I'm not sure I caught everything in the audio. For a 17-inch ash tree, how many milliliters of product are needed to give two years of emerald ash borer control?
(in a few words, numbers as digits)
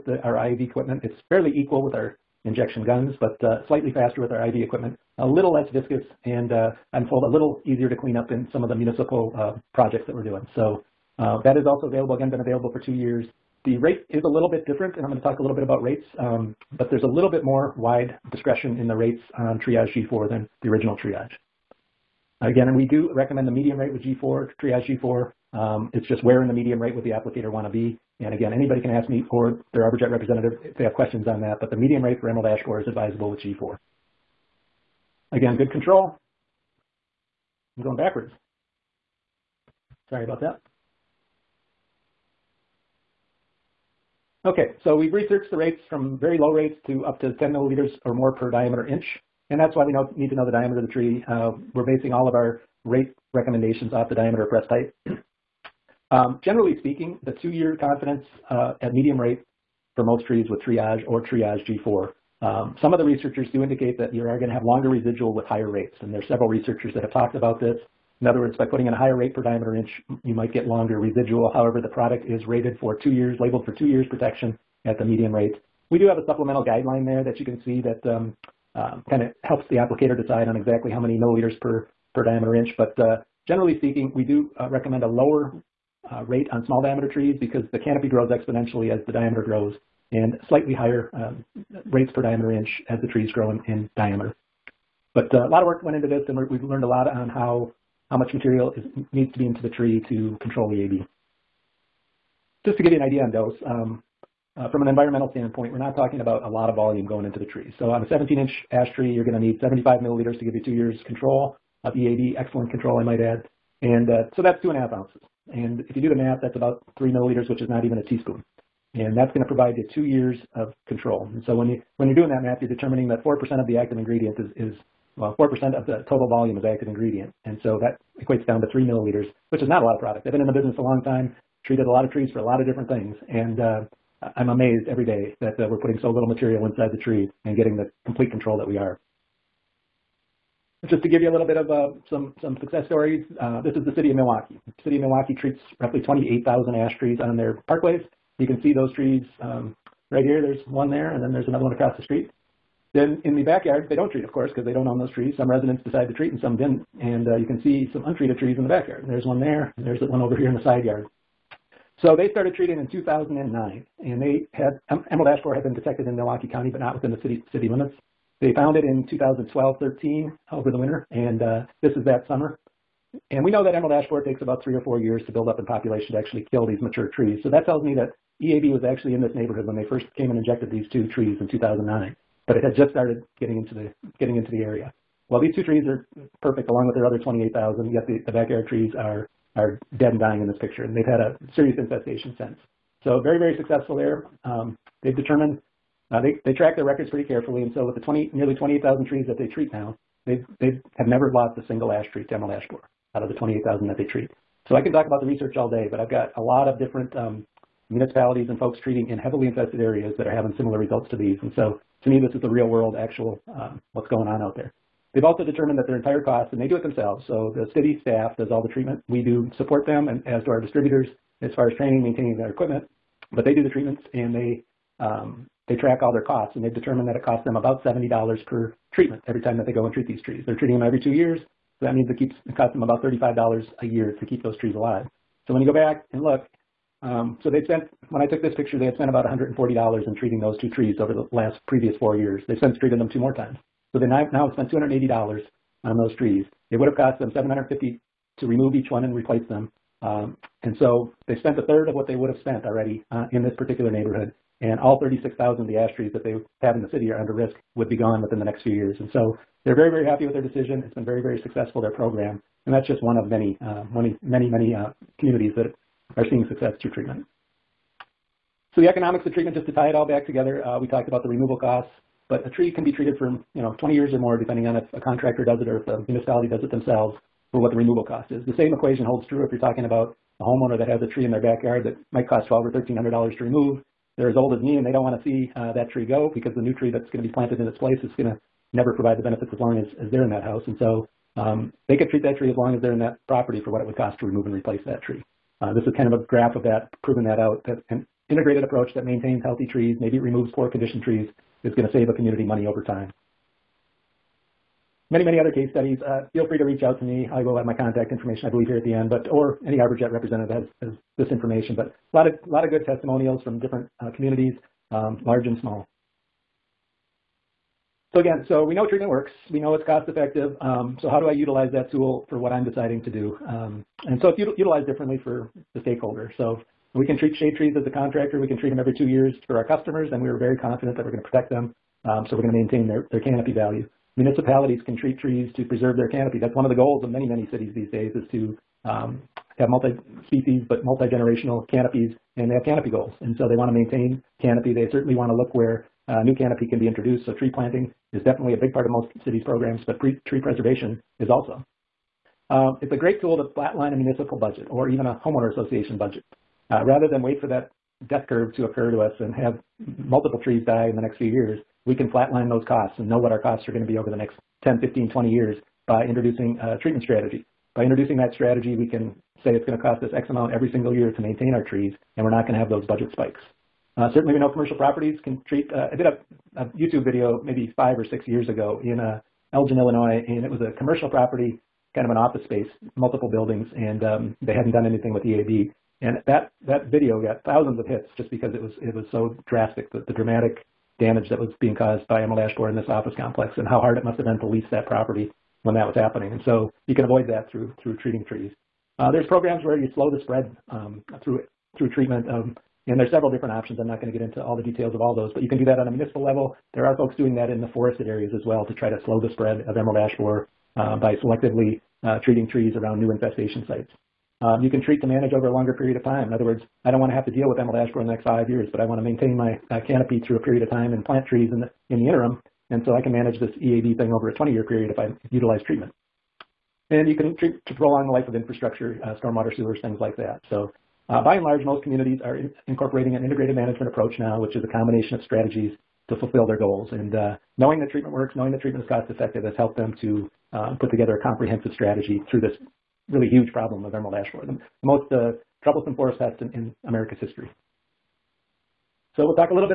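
75 milliliters.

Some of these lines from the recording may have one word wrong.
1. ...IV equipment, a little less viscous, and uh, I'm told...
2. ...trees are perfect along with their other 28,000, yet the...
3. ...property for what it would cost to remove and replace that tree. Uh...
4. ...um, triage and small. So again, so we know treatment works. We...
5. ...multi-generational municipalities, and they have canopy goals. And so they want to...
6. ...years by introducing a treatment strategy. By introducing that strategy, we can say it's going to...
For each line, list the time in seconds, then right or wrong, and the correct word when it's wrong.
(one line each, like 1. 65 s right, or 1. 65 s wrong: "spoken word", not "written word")
1. 4 s right
2. 185 s right
3. 293 s right
4. 314 s wrong: "large", not "triage"
5. 340 s wrong: "canopies", not "municipalities"
6. 365 s right.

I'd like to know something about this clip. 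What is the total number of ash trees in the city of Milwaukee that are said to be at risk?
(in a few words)
36,000.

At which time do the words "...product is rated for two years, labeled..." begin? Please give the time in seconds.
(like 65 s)
71 s.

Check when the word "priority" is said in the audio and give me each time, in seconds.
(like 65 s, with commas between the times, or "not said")
not said.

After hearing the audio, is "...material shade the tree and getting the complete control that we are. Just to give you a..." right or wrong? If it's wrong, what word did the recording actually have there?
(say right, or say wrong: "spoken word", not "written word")
wrong: "inside", not "shade".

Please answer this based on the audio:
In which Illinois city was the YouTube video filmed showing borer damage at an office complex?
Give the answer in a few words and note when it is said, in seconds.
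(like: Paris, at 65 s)
Elgin, at 379 s.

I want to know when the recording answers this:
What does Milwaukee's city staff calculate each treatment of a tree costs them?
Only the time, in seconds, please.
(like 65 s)
227 s.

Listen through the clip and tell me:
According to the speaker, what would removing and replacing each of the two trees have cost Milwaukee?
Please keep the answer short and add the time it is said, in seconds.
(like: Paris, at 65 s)
$750, at 247 s.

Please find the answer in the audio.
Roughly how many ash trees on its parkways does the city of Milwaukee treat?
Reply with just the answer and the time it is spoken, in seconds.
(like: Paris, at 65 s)
28,000, at 146 s.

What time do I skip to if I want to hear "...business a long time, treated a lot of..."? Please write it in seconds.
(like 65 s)
130 s.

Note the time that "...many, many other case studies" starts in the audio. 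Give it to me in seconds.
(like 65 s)
305 s.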